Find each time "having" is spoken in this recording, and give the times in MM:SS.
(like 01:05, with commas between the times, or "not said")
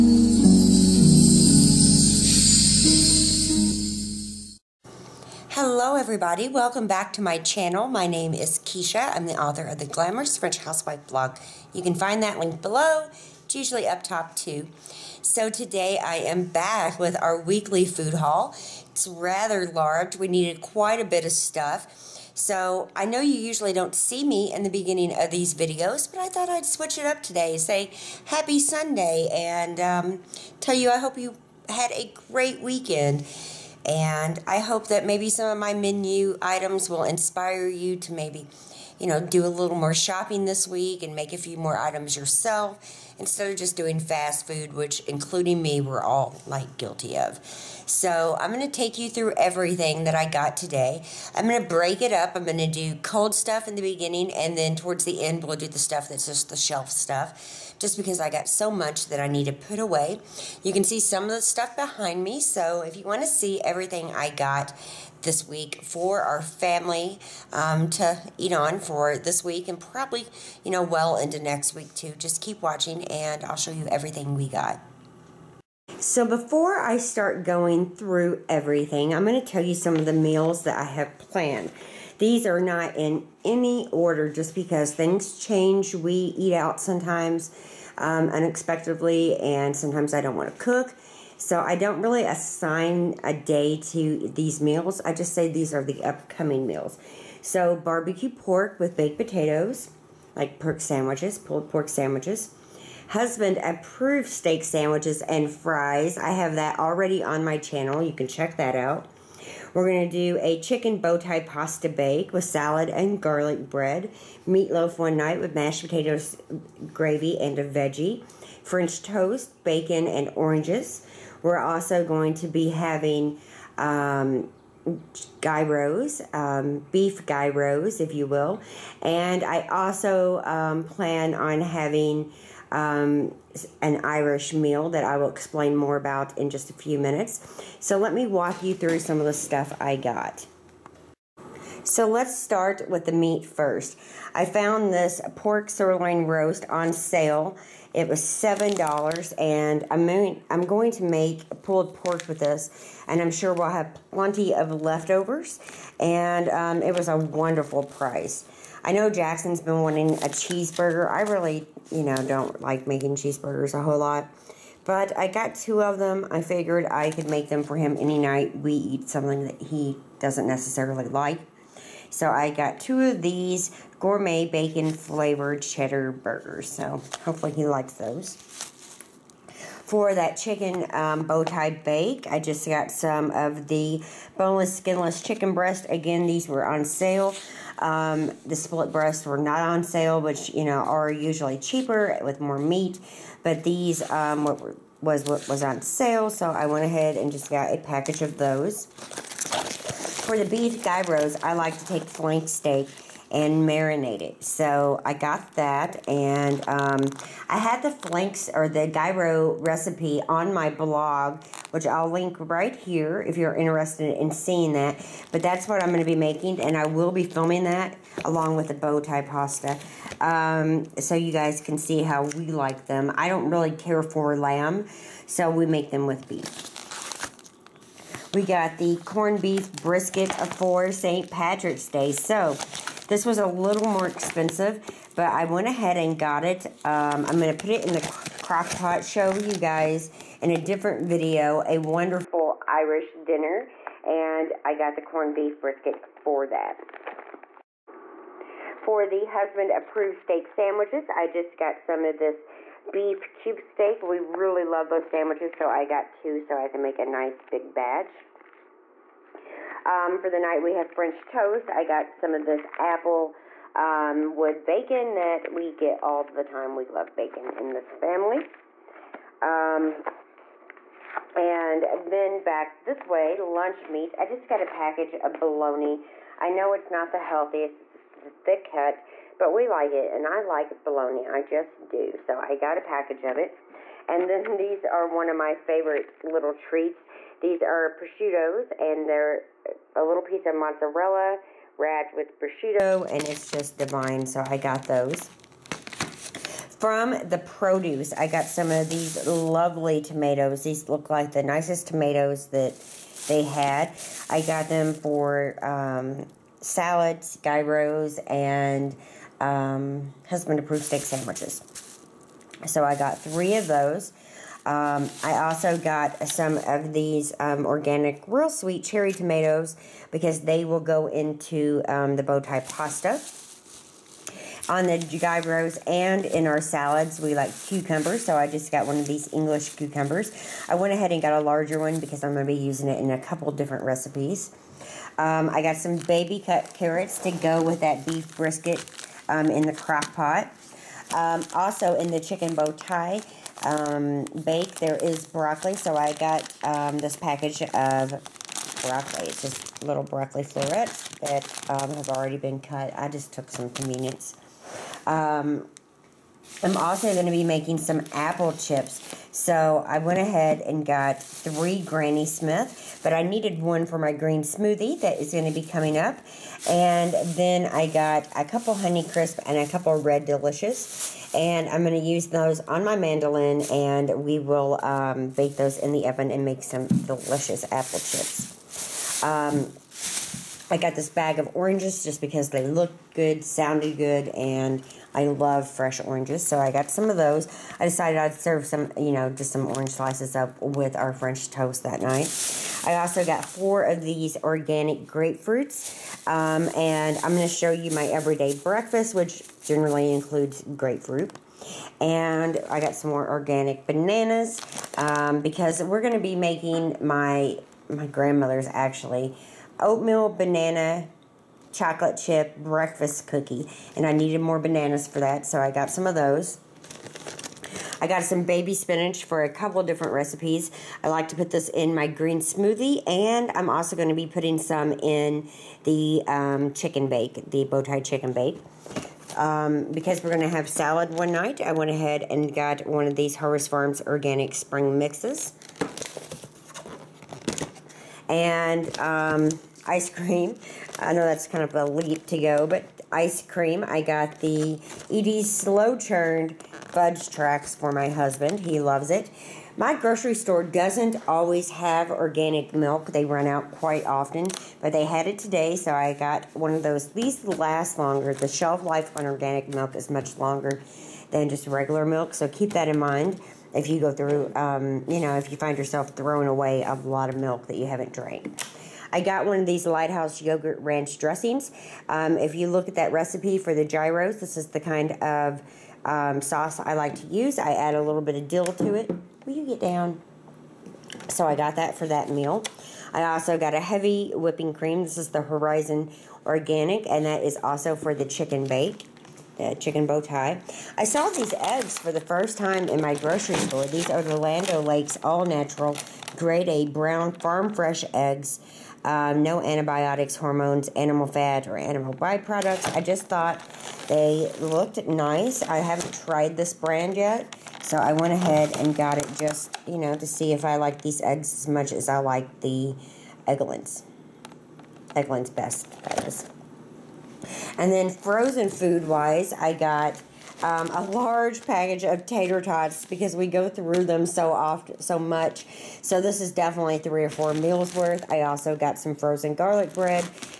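02:02, 02:11.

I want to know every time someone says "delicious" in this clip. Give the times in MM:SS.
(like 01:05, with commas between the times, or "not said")
06:10, 06:16.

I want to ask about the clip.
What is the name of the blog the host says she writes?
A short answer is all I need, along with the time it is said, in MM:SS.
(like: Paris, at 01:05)
Glamorous French Housewife, at 00:09.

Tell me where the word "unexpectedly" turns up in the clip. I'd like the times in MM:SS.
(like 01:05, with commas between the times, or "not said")
01:28.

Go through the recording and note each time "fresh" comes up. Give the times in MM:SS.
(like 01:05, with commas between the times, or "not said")
06:25, 08:17.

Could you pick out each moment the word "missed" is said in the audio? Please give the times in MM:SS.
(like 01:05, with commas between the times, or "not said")
not said.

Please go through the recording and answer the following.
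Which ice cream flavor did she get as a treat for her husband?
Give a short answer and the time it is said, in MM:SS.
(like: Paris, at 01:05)
Slow Churned Fudge Tracks, at 07:25.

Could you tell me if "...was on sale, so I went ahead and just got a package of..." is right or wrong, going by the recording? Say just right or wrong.
right.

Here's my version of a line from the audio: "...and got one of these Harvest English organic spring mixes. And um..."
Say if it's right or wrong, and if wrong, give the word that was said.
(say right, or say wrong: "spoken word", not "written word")
wrong: "Farms", not "English".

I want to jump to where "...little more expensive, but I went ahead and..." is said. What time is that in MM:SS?
03:53.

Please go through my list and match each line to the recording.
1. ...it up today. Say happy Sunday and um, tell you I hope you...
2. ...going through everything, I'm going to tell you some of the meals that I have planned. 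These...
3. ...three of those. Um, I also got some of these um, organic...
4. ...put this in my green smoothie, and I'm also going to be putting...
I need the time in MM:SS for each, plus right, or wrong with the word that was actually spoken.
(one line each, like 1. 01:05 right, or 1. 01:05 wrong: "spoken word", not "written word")
1. 00:26 right
2. 01:17 right
3. 05:13 right
4. 07:01 right.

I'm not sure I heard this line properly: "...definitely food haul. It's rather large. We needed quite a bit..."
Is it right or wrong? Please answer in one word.
wrong.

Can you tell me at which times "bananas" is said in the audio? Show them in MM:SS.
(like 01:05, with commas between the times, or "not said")
06:43, 06:50, 06:54.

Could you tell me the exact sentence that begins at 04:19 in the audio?
Um, for the night, we have French toast.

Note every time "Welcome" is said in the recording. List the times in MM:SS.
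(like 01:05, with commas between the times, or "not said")
00:06.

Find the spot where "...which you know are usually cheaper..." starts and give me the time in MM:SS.
03:10.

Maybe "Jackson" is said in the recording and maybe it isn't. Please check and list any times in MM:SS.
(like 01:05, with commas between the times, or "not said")
02:39.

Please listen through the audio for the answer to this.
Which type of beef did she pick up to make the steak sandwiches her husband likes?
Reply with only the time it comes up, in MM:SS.
04:12.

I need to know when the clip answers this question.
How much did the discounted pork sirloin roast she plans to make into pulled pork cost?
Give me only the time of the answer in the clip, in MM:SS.
02:28.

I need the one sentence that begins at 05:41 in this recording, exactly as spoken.
Um, also in the chicken bow tie um, bake, there is broccoli.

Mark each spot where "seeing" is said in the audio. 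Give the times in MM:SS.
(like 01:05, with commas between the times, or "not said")
03:34.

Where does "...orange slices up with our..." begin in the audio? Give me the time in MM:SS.
06:29.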